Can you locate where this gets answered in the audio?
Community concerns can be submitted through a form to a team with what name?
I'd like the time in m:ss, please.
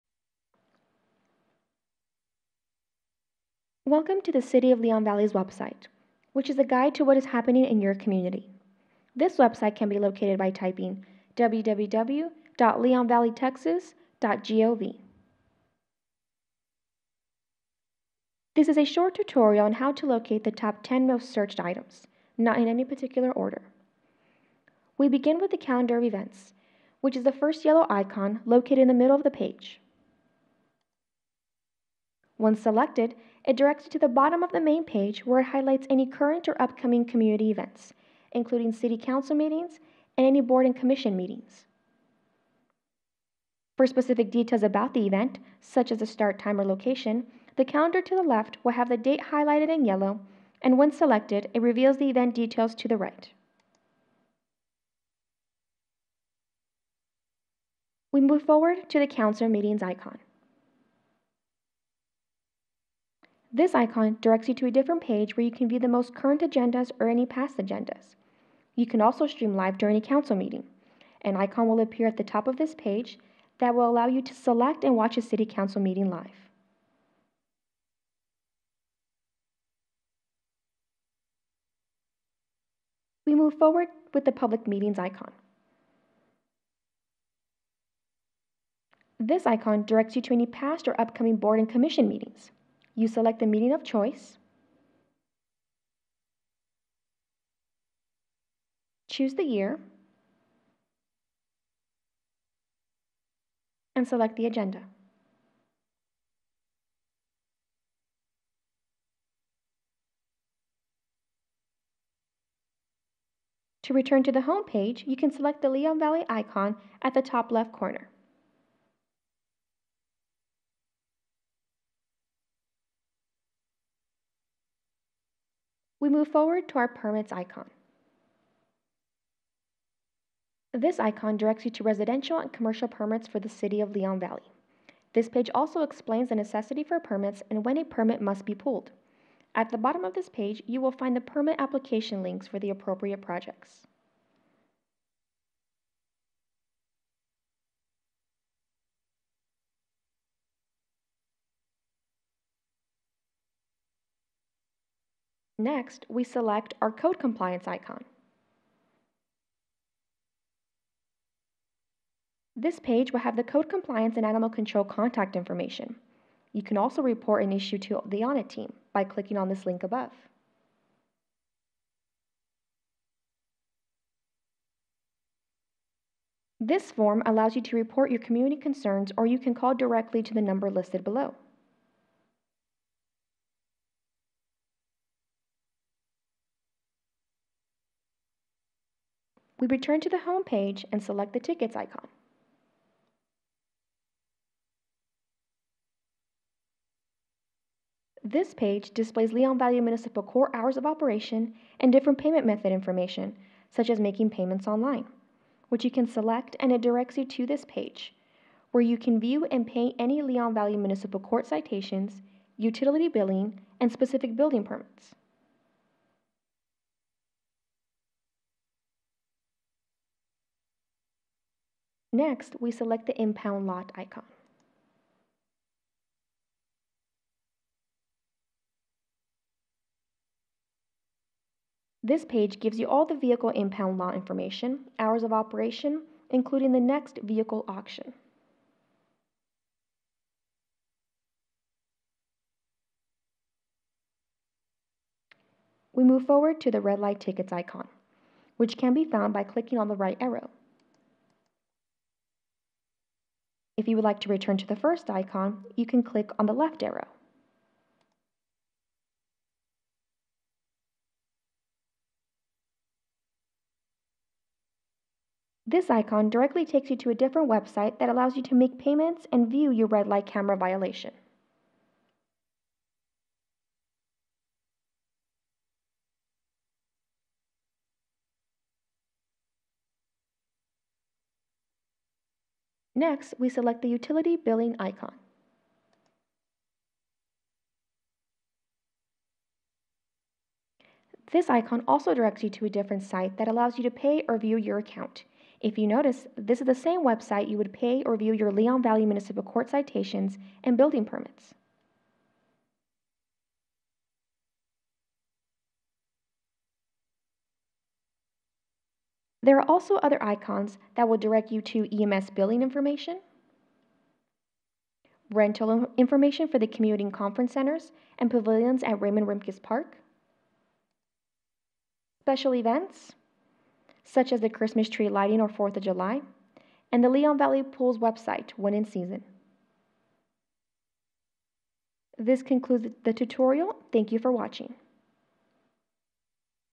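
2:48.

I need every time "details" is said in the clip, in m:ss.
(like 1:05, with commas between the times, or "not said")
0:44, 0:52.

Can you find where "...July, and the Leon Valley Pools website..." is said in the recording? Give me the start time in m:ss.
5:25.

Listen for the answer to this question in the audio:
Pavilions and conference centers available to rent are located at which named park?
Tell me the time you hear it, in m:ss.
5:19.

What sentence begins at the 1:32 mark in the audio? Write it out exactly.
You select the meeting of choice.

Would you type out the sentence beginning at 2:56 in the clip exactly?
This form allows you to report your community concerns or you can call directly to the number listed below.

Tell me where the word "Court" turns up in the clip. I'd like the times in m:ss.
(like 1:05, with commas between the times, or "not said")
3:20, 3:31, 4:59.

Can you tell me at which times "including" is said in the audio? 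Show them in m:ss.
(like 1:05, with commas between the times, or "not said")
0:38, 3:56.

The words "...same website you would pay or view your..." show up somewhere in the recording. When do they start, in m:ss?
4:56.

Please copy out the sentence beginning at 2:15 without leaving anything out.
This page also explains the necessity for permits and when a permit must be pulled.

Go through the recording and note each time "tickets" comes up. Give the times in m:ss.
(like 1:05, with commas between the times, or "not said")
3:11, 4:07.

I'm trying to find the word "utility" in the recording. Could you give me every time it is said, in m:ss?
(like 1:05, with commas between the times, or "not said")
3:32, 4:43.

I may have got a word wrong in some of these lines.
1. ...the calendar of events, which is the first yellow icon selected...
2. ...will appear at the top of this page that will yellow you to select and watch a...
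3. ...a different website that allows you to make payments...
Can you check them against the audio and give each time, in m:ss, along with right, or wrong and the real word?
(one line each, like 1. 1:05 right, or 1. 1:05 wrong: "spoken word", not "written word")
1. 0:25 wrong: "located", not "selected"
2. 1:11 wrong: "allow", not "yellow"
3. 4:27 right.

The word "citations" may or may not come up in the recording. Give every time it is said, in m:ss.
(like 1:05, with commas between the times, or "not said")
3:31, 4:59.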